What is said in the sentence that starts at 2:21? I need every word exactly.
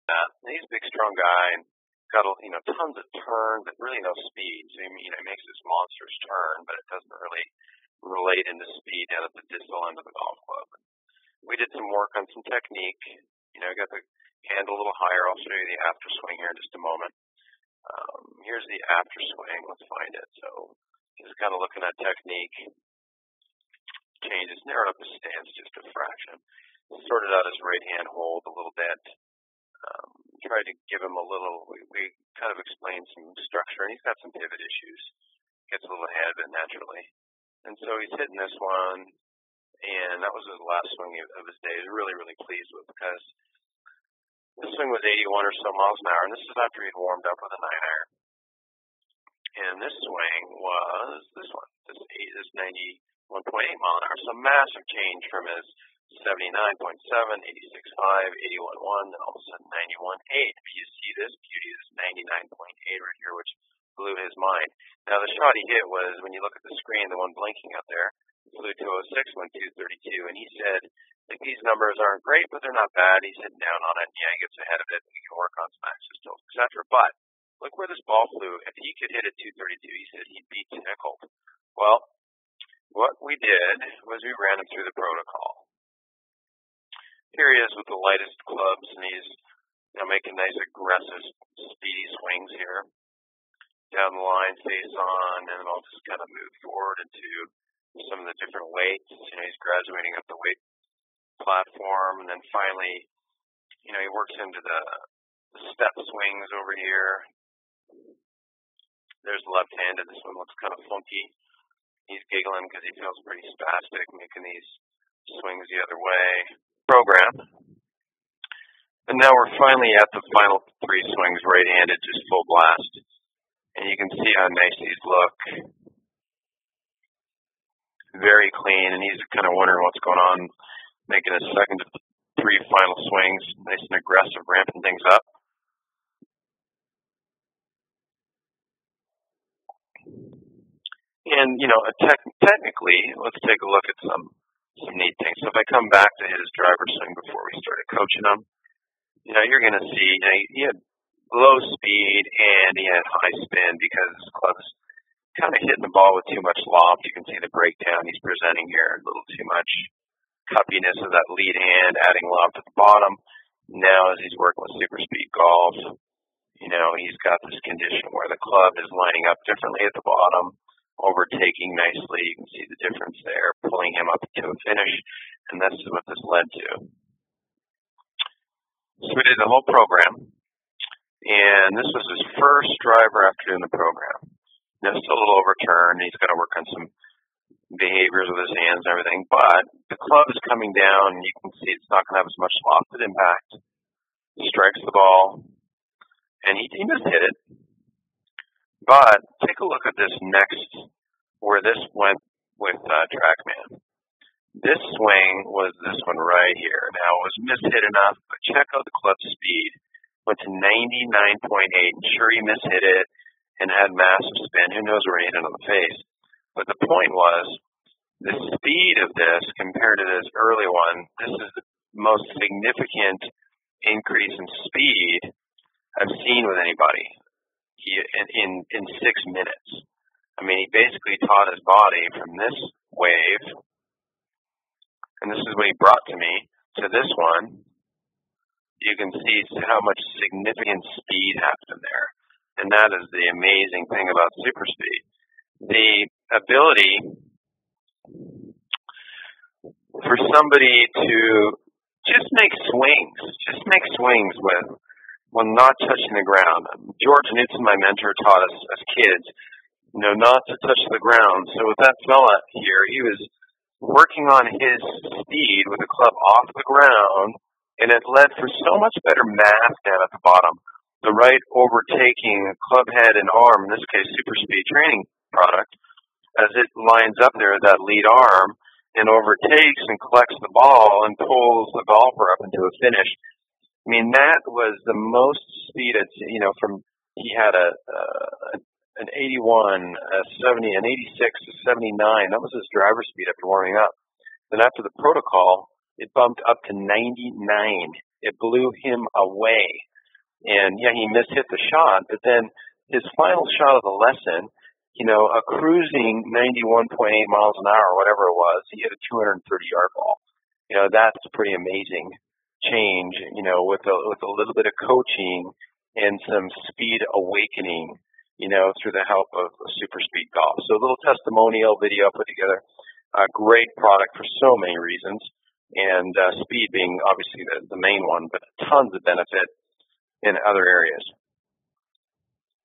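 And, you know, te technically, let's take a look at some some neat things.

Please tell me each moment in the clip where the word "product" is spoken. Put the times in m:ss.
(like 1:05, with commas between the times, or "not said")
4:35, 5:23.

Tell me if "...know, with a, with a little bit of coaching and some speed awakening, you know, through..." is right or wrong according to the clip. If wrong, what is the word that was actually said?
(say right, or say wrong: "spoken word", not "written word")
right.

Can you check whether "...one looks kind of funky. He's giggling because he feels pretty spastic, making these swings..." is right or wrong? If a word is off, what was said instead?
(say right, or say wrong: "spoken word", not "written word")
right.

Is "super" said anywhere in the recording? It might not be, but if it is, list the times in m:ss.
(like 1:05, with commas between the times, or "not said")
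2:44, 4:04, 4:34, 5:19.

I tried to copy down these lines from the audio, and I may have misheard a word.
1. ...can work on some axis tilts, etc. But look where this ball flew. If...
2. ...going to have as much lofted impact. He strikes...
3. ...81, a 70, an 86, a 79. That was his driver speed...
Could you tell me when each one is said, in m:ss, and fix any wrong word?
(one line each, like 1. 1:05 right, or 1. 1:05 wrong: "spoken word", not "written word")
1. 1:15 right
2. 3:12 right
3. 4:49 right.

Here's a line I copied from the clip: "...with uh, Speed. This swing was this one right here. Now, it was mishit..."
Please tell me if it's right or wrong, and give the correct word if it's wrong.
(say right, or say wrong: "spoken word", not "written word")
wrong: "TrackMan", not "Speed".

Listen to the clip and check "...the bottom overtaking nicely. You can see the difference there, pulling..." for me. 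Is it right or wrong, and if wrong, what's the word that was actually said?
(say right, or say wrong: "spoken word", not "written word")
right.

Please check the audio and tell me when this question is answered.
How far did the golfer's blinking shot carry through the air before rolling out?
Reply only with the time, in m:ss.
1:08.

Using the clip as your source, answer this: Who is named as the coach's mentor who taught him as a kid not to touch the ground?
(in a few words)
George Newton.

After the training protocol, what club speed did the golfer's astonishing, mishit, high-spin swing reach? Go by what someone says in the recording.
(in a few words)
99.8 mph.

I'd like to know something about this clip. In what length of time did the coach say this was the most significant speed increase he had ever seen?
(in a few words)
6 minutes.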